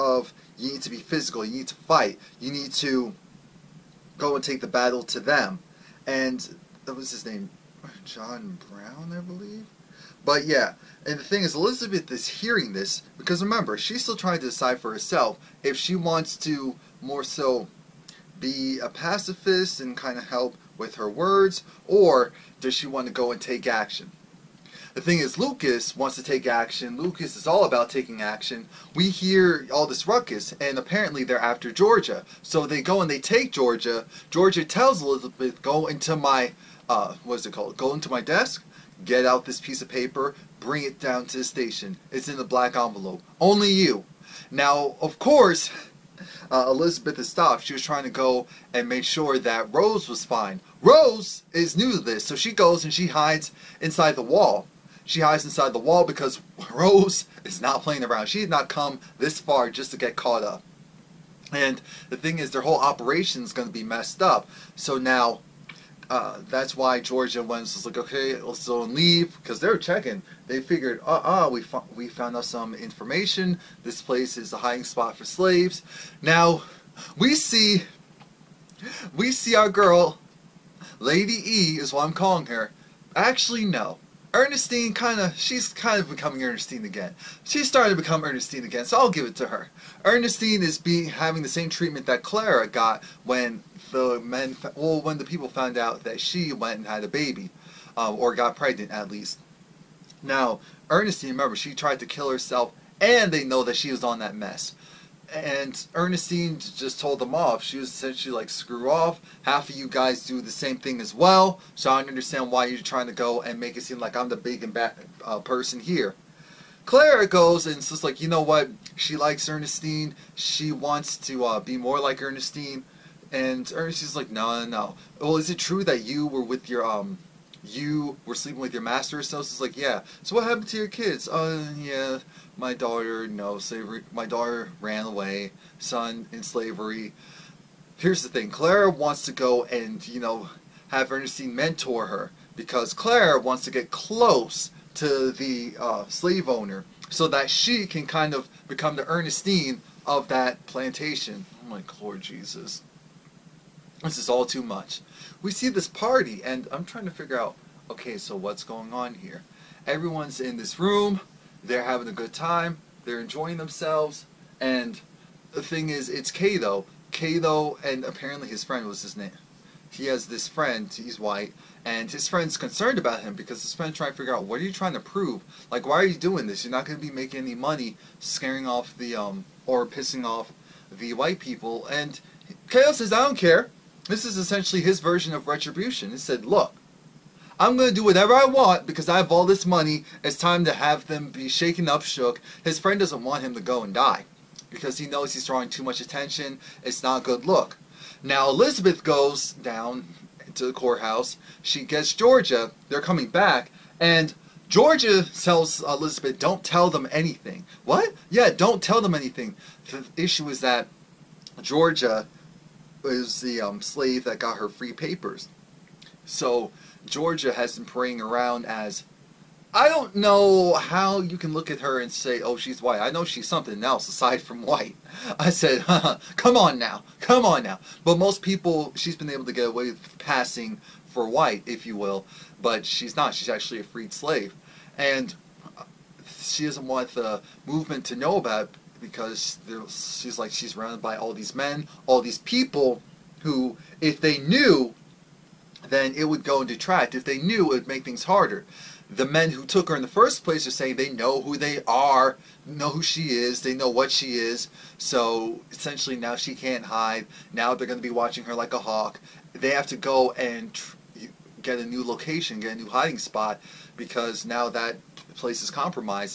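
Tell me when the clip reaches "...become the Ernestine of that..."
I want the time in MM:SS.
02:28.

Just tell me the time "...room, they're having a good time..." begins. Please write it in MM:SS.
02:40.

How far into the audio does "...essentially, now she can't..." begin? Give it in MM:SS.
04:15.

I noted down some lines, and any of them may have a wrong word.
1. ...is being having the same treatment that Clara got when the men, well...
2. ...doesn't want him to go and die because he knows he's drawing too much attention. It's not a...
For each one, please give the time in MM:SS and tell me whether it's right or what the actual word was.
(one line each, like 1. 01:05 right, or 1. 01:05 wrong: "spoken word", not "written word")
1. 01:30 right
2. 03:12 right.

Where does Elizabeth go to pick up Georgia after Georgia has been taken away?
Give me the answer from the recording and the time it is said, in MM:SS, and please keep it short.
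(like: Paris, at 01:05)
The courthouse, at 03:20.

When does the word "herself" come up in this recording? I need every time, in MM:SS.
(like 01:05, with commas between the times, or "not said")
00:14, 01:42.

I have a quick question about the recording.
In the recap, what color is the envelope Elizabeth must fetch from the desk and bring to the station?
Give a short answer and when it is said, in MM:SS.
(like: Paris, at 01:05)
Black, at 00:42.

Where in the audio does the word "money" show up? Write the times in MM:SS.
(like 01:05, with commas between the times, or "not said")
02:57, 03:09.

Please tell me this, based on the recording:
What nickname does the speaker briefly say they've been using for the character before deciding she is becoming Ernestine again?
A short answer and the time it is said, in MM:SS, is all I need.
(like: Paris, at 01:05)
Lady E, at 01:20.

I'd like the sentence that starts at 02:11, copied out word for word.
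Oh, yeah, my daughter, no slavery.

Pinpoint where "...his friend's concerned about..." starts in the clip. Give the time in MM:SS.
02:52.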